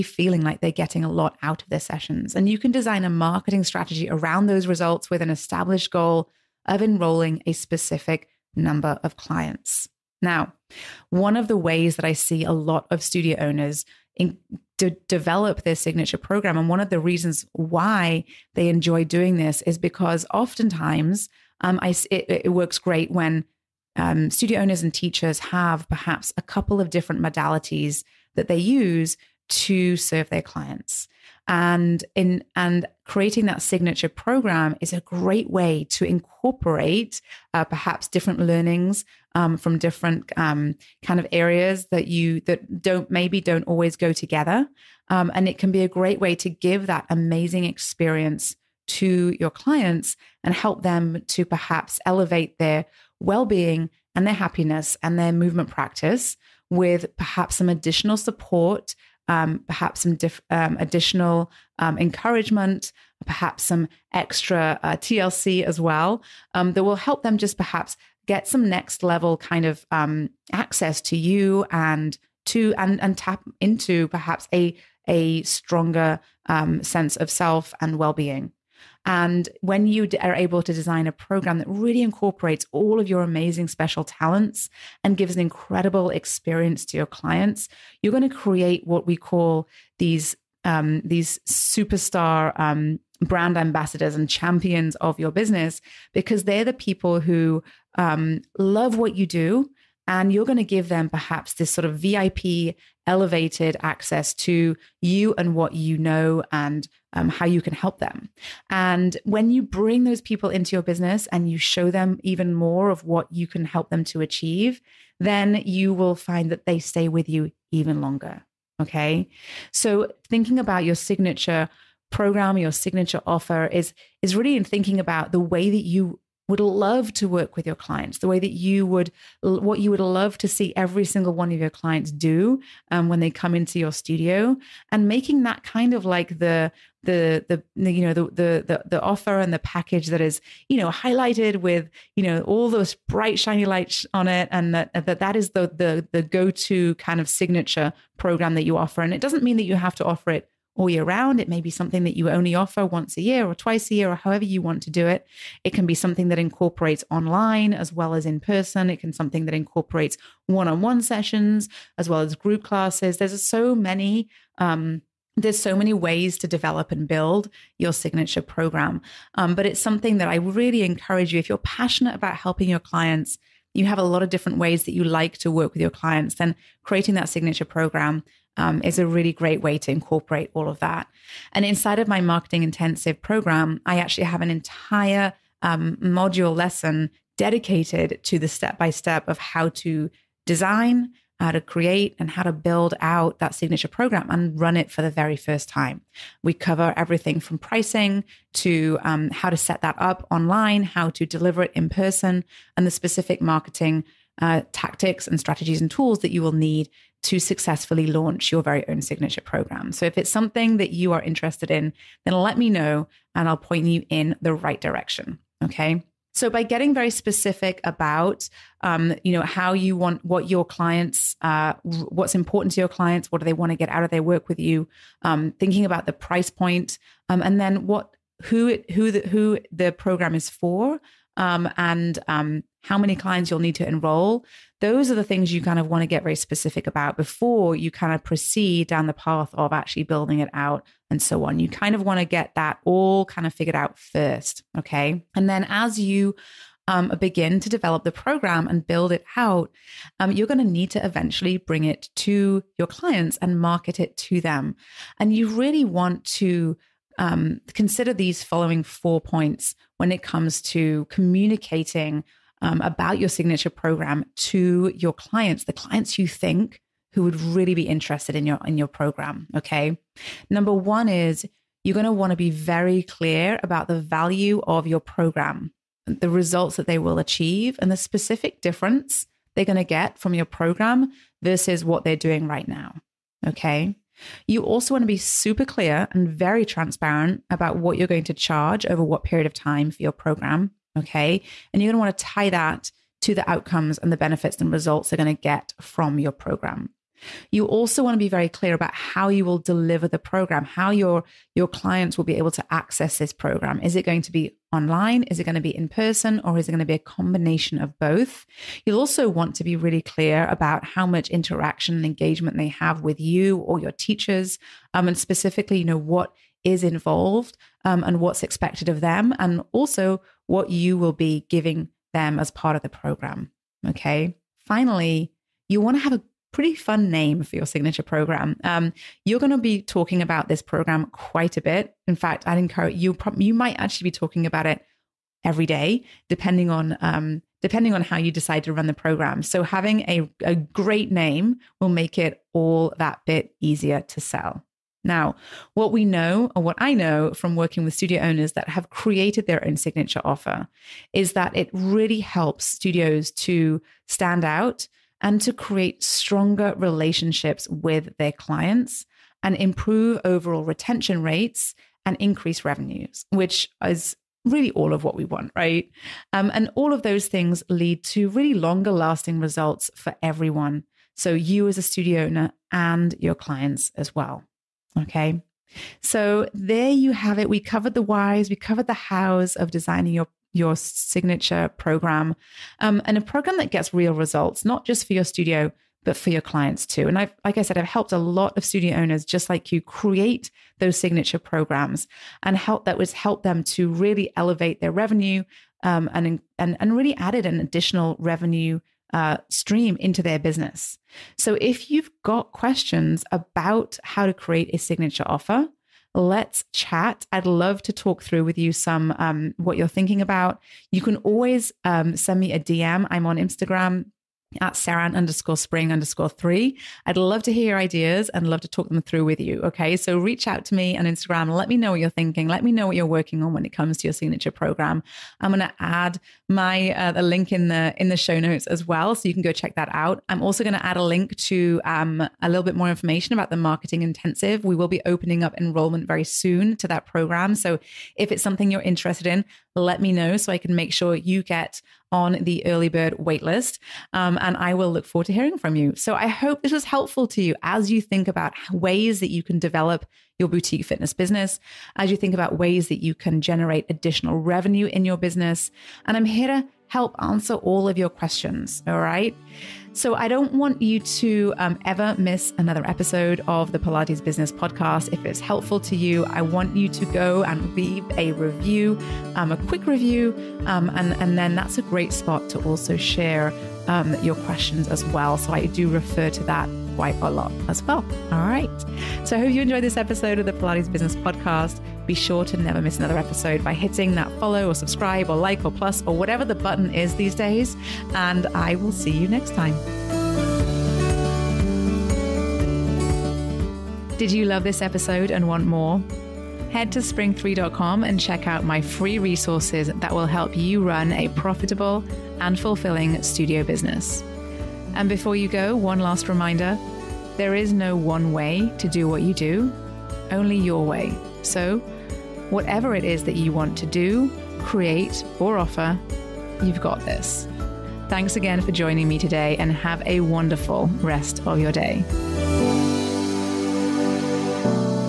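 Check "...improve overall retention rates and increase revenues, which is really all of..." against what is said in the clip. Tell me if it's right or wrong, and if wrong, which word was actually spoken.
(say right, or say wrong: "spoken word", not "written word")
right.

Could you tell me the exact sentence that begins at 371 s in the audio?
So, you as a studio owner and your clients as well.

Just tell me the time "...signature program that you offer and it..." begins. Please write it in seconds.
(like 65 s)
147 s.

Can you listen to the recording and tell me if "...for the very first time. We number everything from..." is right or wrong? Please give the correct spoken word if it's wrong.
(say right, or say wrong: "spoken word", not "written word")
wrong: "cover", not "number".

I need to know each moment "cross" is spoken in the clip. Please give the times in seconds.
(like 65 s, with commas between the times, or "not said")
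not said.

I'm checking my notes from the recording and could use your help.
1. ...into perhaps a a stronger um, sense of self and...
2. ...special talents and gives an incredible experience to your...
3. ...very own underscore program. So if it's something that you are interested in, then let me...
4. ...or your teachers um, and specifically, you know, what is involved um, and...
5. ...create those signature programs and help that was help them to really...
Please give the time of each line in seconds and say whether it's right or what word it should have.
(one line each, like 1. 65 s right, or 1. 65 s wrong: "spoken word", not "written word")
1. 73 s right
2. 83 s right
3. 208 s wrong: "signature", not "underscore"
4. 313 s right
5. 389 s right.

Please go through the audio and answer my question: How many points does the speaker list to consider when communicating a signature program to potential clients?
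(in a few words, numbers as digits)
4.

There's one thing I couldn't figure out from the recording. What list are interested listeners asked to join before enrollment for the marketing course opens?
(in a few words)
early bird waitlist.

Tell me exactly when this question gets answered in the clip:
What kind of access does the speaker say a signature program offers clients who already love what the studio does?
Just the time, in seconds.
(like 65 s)
101 s.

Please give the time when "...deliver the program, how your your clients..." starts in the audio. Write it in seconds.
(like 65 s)
299 s.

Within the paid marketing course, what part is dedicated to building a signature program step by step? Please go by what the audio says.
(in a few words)
module lesson.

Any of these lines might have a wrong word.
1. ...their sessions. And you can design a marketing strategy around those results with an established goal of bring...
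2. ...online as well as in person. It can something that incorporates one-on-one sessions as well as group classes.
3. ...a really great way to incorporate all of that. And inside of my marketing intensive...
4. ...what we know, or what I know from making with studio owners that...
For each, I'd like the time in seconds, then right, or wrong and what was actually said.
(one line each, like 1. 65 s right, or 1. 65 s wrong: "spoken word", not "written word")
1. 1 s wrong: "enrolling", not "bring"
2. 157 s right
3. 178 s right
4. 345 s wrong: "working", not "making".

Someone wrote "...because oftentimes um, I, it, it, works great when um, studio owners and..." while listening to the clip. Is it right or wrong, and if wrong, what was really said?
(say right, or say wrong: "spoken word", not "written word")
right.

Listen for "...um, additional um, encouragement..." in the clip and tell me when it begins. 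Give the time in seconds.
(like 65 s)
60 s.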